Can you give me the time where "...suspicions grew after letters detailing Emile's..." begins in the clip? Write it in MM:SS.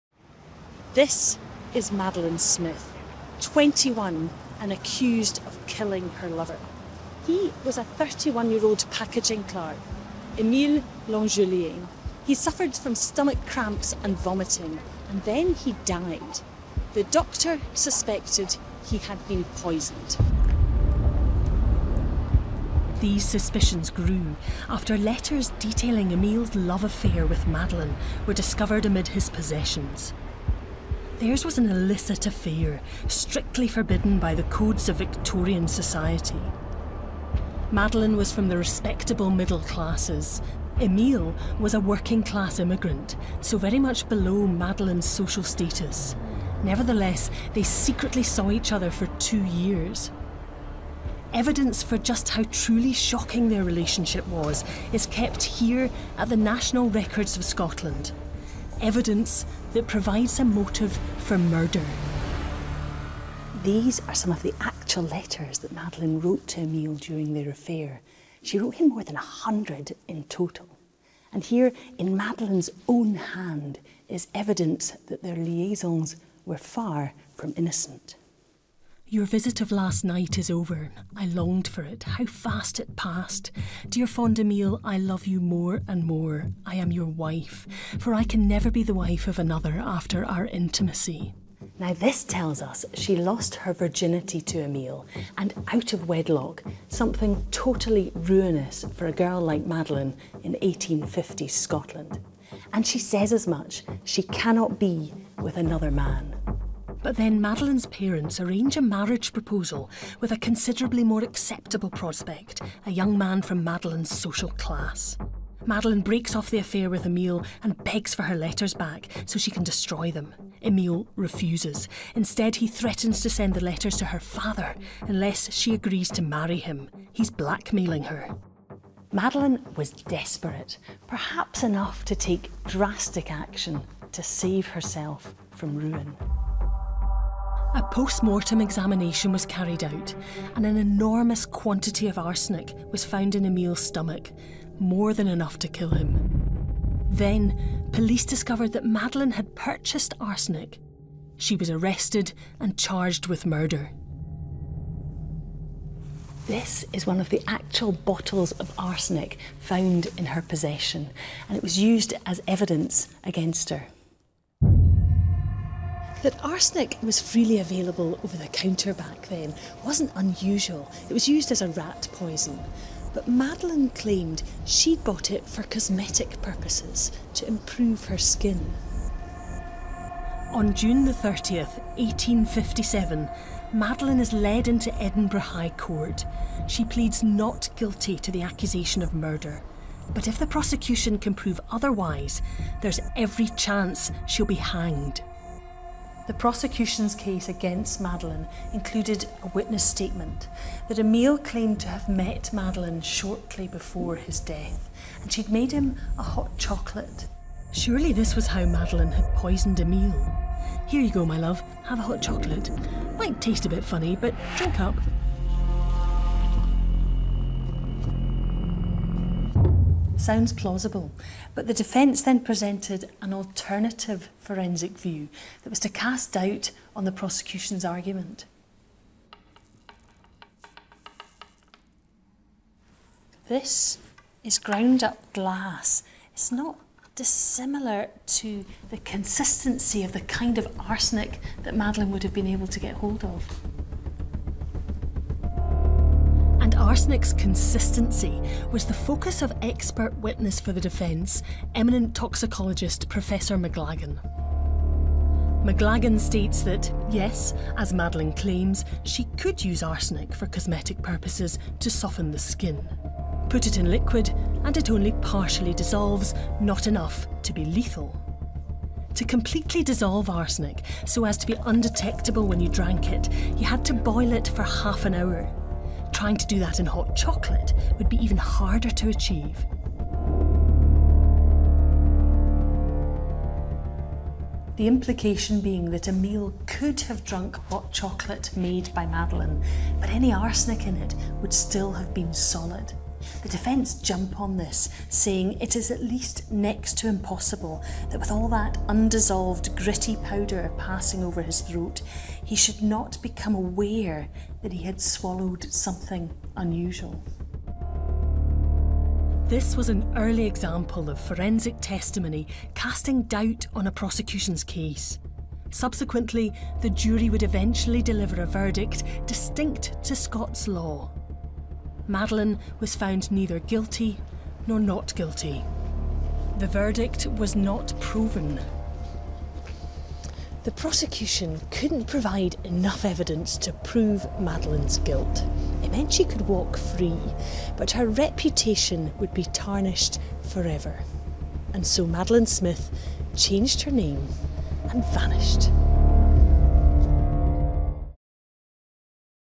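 00:23.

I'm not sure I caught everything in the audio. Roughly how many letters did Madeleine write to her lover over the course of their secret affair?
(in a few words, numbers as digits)
More than 100.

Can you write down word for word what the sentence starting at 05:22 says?
Madeleine was found neither guilty nor not guilty.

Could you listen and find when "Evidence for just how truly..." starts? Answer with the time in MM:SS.
00:51.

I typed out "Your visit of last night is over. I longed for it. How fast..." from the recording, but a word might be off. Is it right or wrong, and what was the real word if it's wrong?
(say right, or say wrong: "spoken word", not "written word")
right.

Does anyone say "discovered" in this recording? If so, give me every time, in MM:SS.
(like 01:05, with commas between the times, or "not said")
00:28, 02:28.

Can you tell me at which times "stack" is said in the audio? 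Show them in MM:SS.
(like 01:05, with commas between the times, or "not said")
not said.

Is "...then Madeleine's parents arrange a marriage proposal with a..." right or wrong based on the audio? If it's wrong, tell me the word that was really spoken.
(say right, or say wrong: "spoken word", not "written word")
right.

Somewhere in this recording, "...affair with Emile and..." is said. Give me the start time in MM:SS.
01:56.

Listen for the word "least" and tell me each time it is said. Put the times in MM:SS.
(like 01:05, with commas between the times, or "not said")
04:56.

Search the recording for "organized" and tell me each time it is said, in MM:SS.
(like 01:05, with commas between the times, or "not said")
not said.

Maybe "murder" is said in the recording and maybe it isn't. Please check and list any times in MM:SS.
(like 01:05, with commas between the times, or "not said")
01:01, 02:33, 03:09.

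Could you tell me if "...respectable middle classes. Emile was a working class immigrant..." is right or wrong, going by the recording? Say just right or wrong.
right.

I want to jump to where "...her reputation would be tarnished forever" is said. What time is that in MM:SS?
05:37.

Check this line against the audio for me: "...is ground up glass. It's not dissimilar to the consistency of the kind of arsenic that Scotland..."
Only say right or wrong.
wrong.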